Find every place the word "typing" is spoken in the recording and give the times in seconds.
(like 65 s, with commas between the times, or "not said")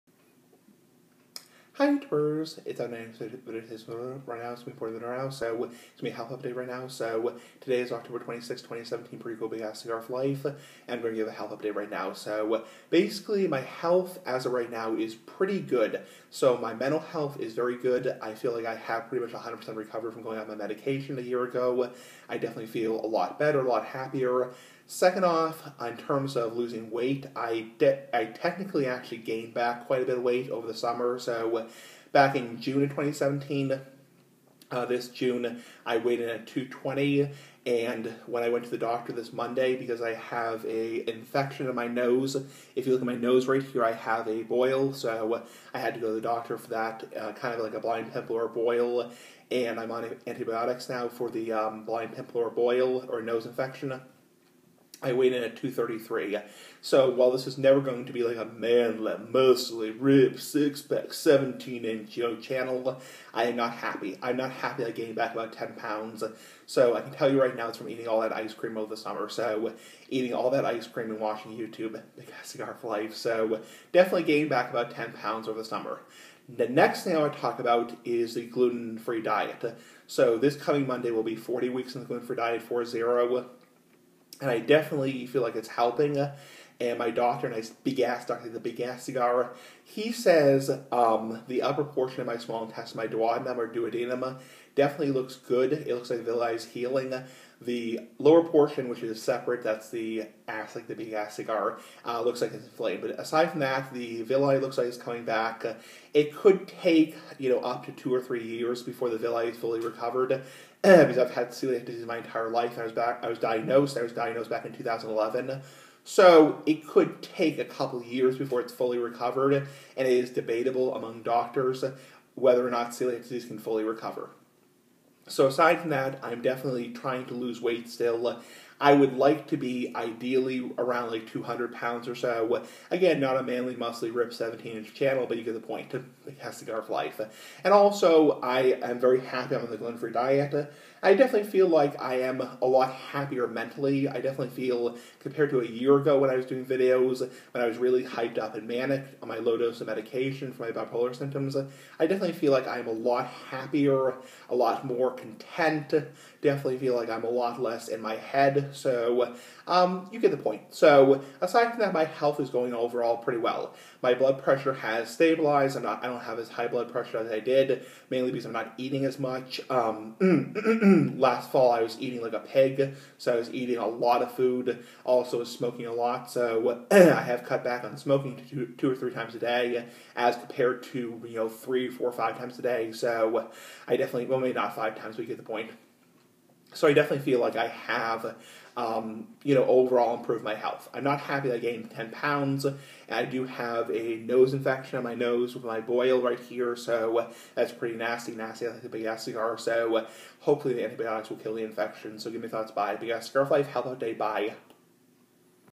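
not said.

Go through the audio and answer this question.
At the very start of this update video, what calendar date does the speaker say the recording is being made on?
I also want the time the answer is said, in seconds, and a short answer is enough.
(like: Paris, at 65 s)
October 26, 2017, at 7 s.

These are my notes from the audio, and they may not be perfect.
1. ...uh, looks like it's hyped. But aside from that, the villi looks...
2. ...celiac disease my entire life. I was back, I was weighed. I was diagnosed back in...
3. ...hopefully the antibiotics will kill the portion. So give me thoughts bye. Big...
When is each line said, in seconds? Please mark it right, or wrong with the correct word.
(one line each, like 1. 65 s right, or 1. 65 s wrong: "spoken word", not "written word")
1. 102 s wrong: "inflamed", not "hyped"
2. 111 s wrong: "diagnosed", not "weighed"
3. 200 s wrong: "infection", not "portion".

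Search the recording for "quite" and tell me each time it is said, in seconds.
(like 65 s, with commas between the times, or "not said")
29 s.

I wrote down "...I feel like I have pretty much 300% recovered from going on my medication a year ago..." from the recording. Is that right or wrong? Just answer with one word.
wrong.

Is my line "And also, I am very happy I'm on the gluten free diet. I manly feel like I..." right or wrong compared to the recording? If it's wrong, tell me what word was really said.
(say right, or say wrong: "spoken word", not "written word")
wrong: "definitely", not "manly".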